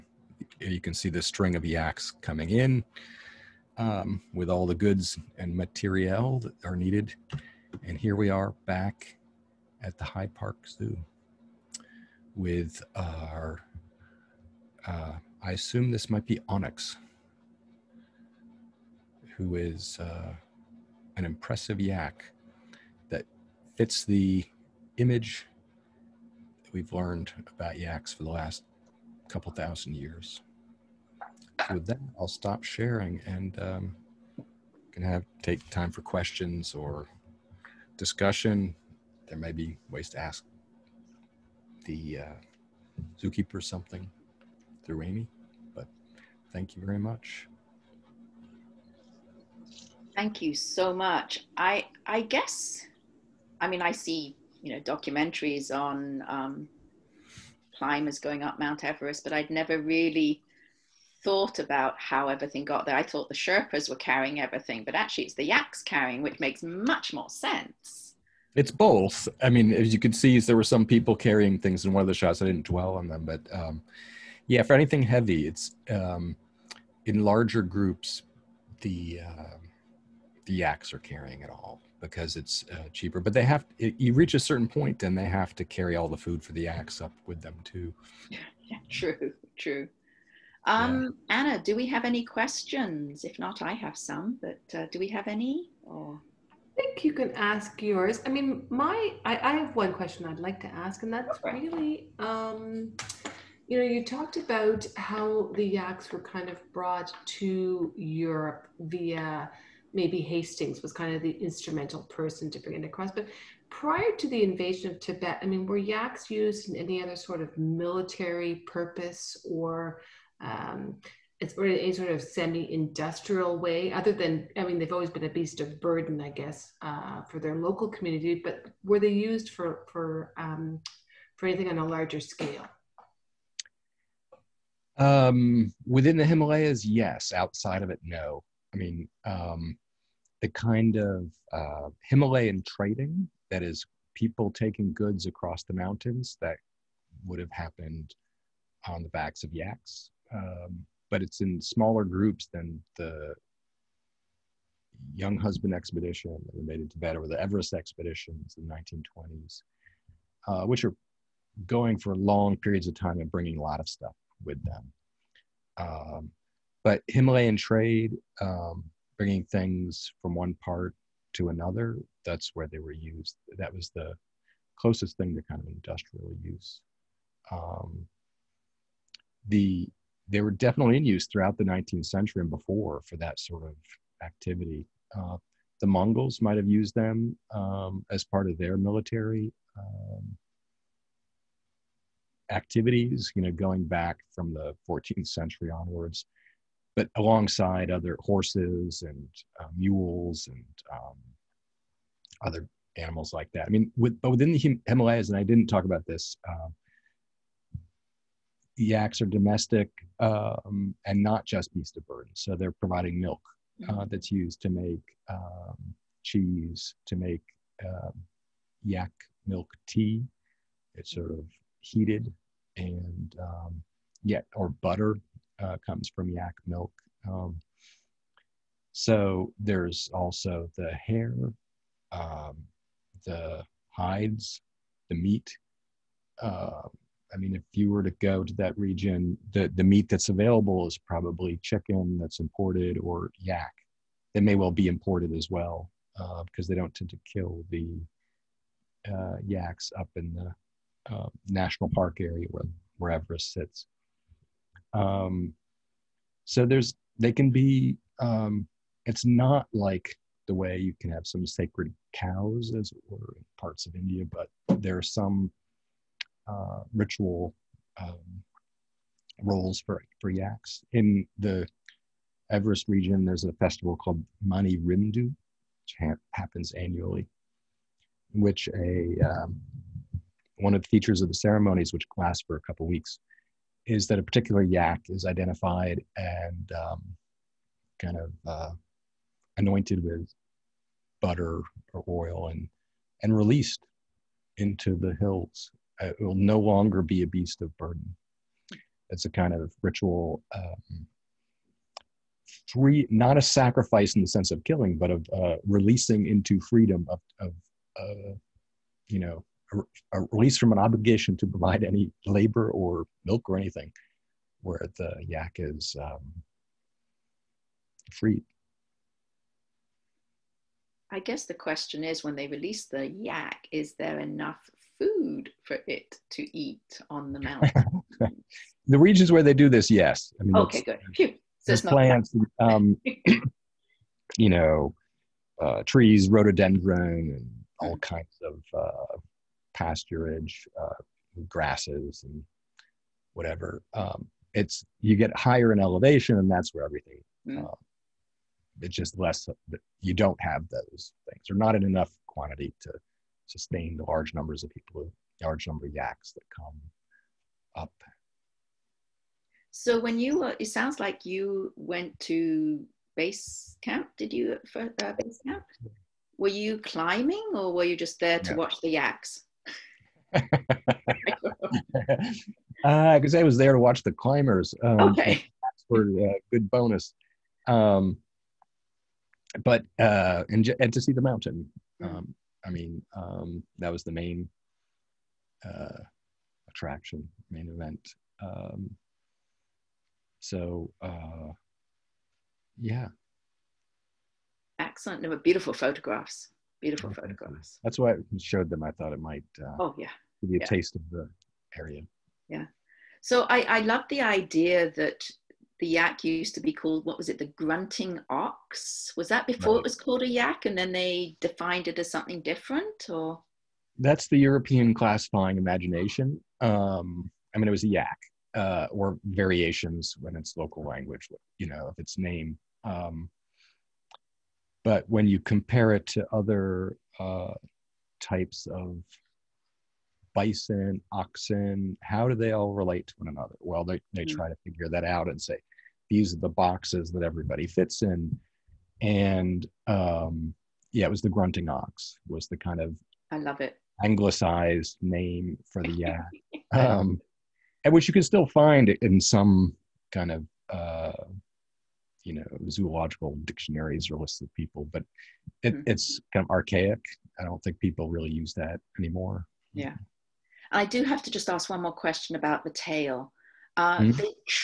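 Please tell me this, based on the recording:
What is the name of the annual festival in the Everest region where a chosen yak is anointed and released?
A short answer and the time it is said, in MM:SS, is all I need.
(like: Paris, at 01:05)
Mani Rimdu, at 04:34.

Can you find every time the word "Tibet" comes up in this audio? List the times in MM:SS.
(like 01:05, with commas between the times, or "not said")
01:54, 02:36.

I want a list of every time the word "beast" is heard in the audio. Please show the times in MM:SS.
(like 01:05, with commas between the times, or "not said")
02:05, 03:31, 04:57.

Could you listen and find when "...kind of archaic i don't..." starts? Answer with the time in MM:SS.
07:36.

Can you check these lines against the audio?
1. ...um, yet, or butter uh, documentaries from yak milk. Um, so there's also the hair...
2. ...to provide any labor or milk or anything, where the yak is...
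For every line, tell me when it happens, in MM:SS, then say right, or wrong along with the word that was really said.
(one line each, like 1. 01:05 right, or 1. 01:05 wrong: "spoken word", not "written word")
1. 03:43 wrong: "comes", not "documentaries"
2. 05:11 right.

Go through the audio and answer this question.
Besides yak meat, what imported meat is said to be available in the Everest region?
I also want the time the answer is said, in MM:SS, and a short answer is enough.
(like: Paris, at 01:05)
chicken, at 04:01.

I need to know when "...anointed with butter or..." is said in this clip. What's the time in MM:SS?
04:49.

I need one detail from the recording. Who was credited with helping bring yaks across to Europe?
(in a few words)
Hastings.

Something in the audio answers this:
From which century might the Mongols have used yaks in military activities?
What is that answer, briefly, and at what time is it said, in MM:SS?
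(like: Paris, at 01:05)
14th century, at 03:14.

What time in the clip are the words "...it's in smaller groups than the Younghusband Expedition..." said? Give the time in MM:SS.
02:31.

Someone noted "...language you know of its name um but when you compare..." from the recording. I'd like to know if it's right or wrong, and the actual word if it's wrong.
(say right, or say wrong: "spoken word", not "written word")
right.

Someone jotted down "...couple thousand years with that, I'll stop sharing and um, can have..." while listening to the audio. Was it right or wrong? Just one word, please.
right.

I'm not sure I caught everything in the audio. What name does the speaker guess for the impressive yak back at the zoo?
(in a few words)
Onyx.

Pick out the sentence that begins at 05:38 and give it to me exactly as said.
kinds of uh, pasturage, uh, grasses, and whatever.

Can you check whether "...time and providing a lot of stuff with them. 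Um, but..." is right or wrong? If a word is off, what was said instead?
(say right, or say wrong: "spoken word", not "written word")
wrong: "bringing", not "providing".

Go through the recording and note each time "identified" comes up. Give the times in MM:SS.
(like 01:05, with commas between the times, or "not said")
04:45.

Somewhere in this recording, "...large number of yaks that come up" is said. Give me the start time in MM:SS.
05:55.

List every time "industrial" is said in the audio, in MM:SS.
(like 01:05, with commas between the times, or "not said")
02:02, 02:55.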